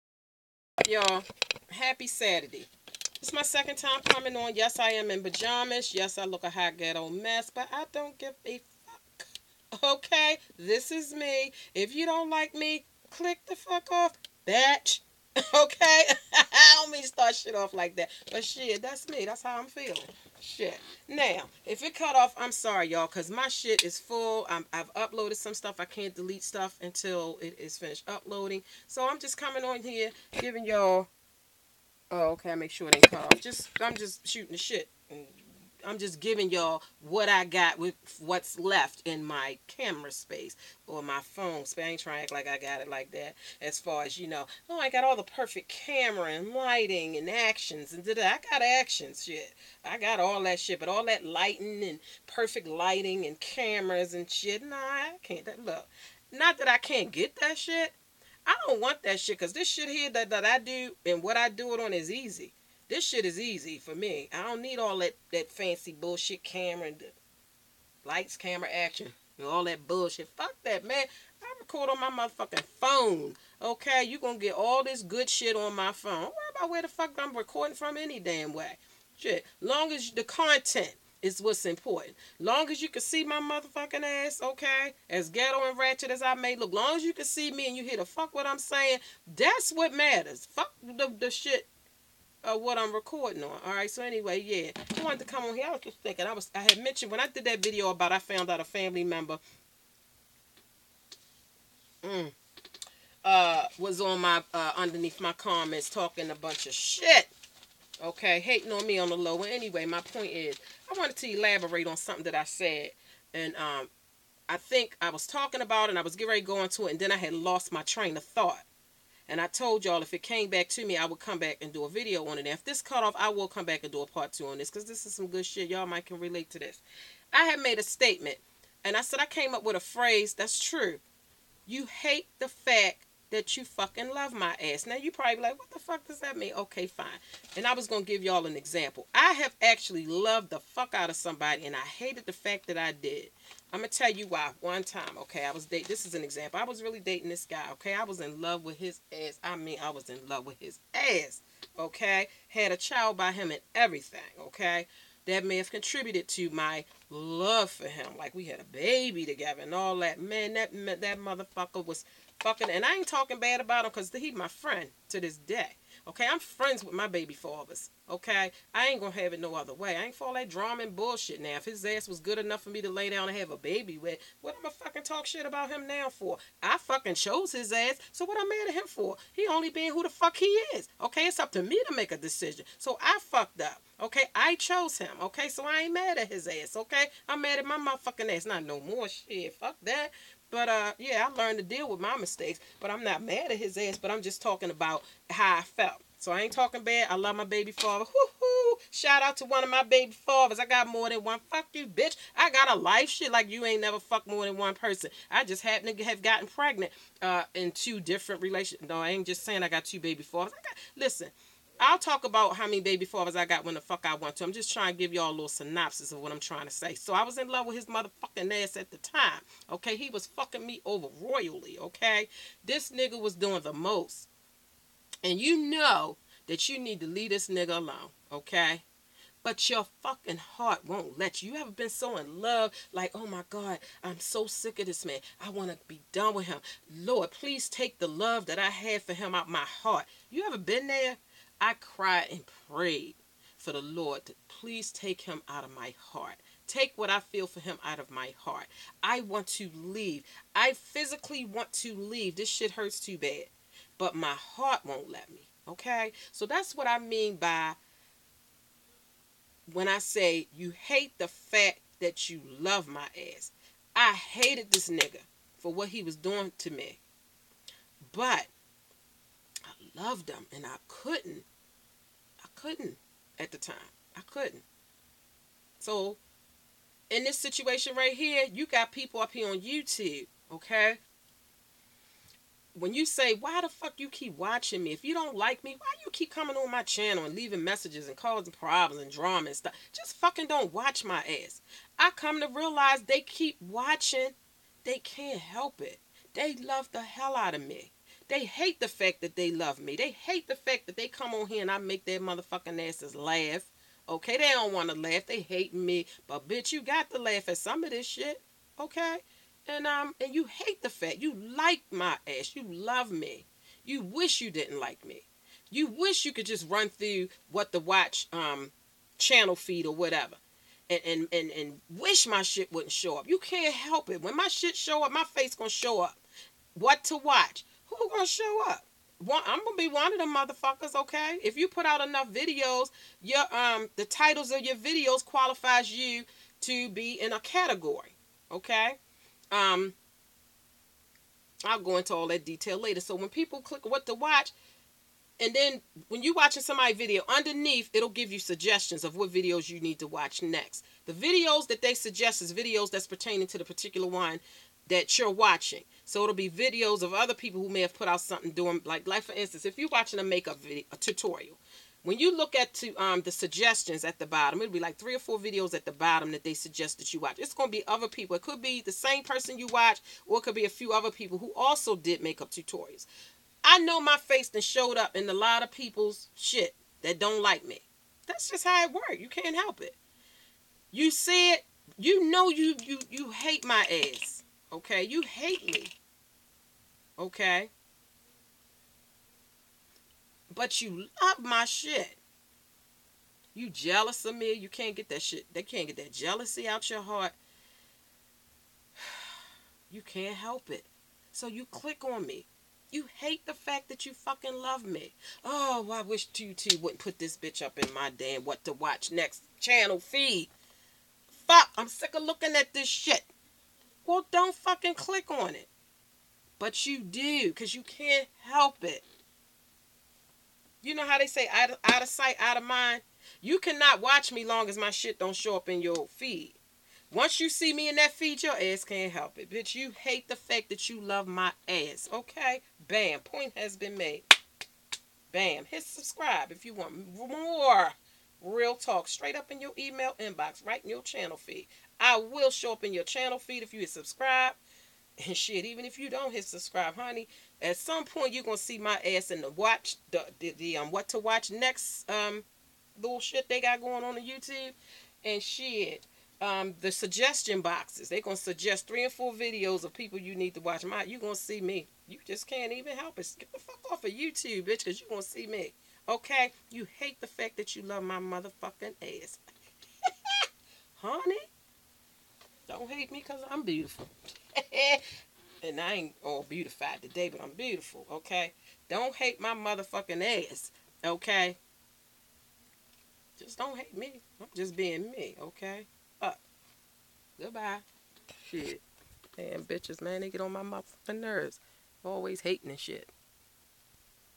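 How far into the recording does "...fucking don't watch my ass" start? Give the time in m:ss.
4:50.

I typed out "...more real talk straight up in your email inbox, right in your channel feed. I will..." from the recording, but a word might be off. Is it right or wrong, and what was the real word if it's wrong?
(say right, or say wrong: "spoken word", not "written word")
right.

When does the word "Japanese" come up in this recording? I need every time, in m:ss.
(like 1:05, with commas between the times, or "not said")
not said.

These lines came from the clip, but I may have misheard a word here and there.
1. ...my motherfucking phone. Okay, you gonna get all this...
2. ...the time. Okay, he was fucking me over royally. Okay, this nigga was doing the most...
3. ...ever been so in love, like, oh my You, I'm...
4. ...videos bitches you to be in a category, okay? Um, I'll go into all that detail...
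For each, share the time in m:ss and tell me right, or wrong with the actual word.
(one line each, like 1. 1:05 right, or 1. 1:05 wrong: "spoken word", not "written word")
1. 1:12 right
2. 3:38 right
3. 3:51 wrong: "God", not "You"
4. 5:34 wrong: "qualifies", not "bitches".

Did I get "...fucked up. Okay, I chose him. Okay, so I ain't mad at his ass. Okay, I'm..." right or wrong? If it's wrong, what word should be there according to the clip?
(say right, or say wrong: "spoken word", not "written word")
right.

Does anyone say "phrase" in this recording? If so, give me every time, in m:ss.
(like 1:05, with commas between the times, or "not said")
2:09.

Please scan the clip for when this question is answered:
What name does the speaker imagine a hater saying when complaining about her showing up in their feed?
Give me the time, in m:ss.
6:46.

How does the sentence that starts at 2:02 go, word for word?
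And if this cut off, I will come back and do a part two on this because this is some good shit.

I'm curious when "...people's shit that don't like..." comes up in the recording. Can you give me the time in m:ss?
6:15.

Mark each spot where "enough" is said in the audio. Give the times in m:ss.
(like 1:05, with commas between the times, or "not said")
2:52, 5:32.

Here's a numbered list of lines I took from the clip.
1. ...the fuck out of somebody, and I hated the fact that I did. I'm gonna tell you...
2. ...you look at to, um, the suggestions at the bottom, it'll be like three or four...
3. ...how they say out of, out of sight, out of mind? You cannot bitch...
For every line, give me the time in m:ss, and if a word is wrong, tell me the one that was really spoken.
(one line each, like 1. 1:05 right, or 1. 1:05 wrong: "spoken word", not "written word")
1. 2:20 right
2. 6:02 right
3. 7:01 wrong: "watch", not "bitch".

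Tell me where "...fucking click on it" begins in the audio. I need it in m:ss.
6:54.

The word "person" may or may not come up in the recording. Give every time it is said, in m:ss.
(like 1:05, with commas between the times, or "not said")
3:24, 6:09.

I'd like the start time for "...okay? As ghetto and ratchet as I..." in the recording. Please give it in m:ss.
1:24.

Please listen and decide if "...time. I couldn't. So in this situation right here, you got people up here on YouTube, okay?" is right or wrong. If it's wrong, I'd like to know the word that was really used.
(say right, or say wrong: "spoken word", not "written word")
right.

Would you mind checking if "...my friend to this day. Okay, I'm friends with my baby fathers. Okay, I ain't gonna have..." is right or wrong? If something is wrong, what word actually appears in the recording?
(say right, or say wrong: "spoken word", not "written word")
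right.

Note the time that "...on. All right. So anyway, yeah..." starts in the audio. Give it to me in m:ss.
1:33.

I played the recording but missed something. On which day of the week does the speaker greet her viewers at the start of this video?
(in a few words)
Saturday.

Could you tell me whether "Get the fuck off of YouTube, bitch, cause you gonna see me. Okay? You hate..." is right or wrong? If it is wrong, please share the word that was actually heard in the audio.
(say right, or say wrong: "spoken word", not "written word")
right.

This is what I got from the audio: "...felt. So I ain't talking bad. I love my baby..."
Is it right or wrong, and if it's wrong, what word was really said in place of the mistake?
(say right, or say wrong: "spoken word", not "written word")
right.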